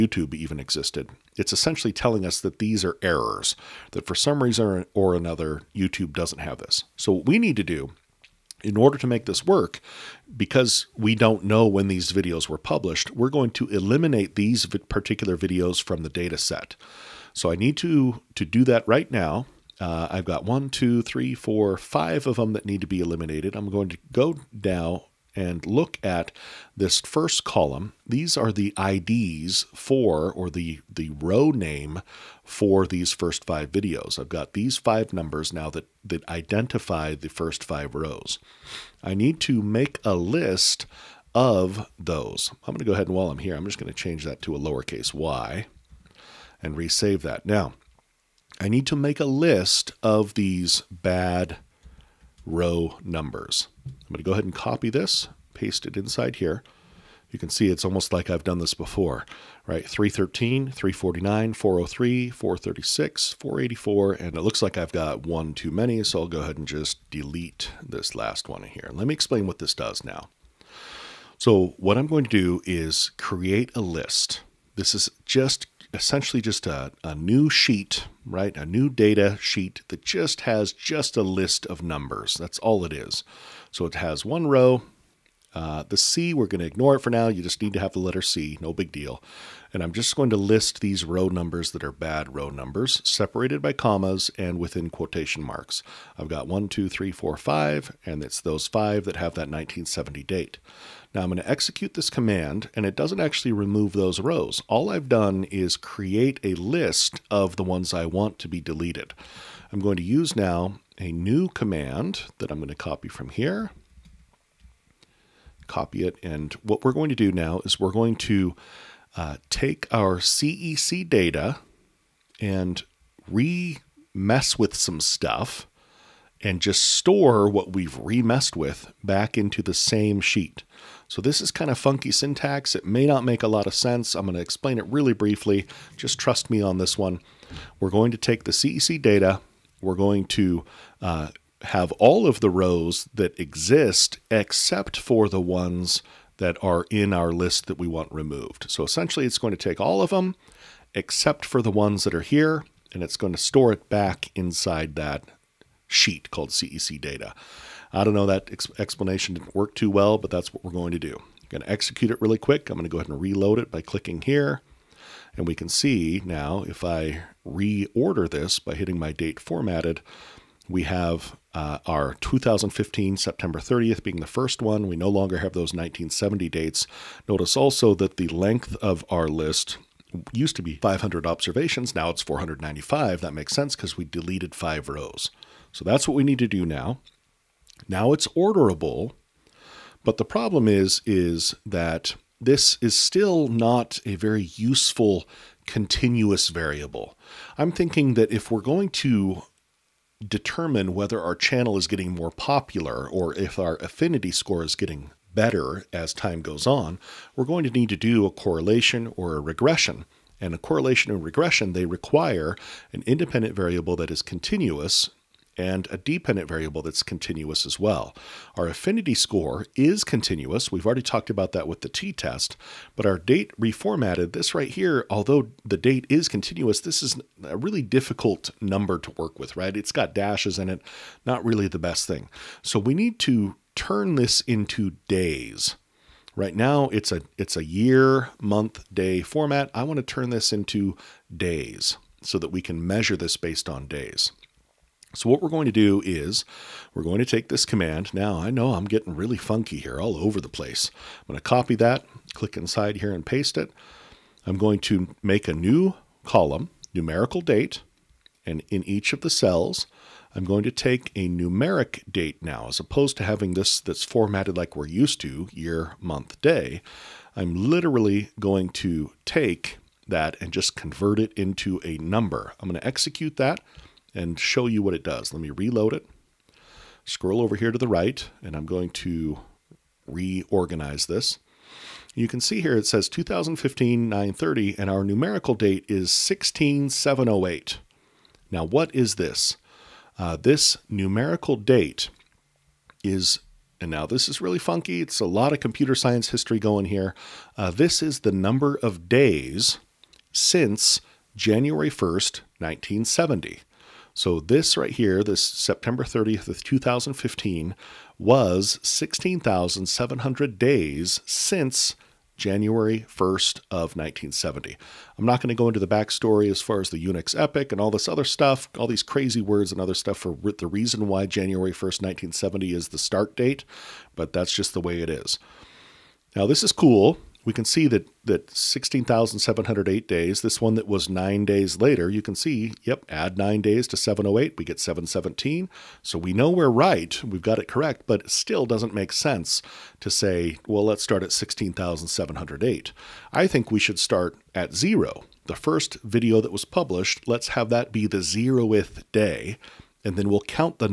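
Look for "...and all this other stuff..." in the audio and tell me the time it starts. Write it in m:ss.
5:17.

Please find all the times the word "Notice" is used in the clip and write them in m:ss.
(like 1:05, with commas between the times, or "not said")
2:57.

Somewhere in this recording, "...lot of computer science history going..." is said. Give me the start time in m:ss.
4:55.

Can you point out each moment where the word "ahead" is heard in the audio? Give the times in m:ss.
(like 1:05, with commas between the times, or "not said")
0:42, 0:54, 1:06, 2:42.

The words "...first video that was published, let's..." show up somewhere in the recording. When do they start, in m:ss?
5:45.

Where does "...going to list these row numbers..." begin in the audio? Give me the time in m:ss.
1:30.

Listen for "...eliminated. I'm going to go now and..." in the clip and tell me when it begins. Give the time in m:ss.
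0:23.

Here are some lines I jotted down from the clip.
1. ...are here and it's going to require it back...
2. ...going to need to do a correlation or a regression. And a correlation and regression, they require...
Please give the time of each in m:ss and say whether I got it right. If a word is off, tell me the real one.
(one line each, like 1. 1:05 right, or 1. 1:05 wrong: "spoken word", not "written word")
1. 2:32 wrong: "store", not "require"
2. 3:27 right.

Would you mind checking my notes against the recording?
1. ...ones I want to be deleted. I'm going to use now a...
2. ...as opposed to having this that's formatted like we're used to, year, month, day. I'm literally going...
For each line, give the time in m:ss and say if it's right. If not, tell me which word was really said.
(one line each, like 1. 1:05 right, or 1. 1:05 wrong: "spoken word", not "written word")
1. 1:47 right
2. 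4:22 right.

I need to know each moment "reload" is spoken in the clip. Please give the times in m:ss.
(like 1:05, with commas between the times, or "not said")
2:43, 4:35.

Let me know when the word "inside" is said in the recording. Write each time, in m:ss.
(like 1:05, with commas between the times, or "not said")
0:55, 2:34, 4:12.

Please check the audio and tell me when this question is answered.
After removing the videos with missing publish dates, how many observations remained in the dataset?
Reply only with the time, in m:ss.
3:01.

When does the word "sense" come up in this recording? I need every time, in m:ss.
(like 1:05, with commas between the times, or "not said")
2:13, 3:03, 5:39.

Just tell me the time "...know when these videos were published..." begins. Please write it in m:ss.
0:11.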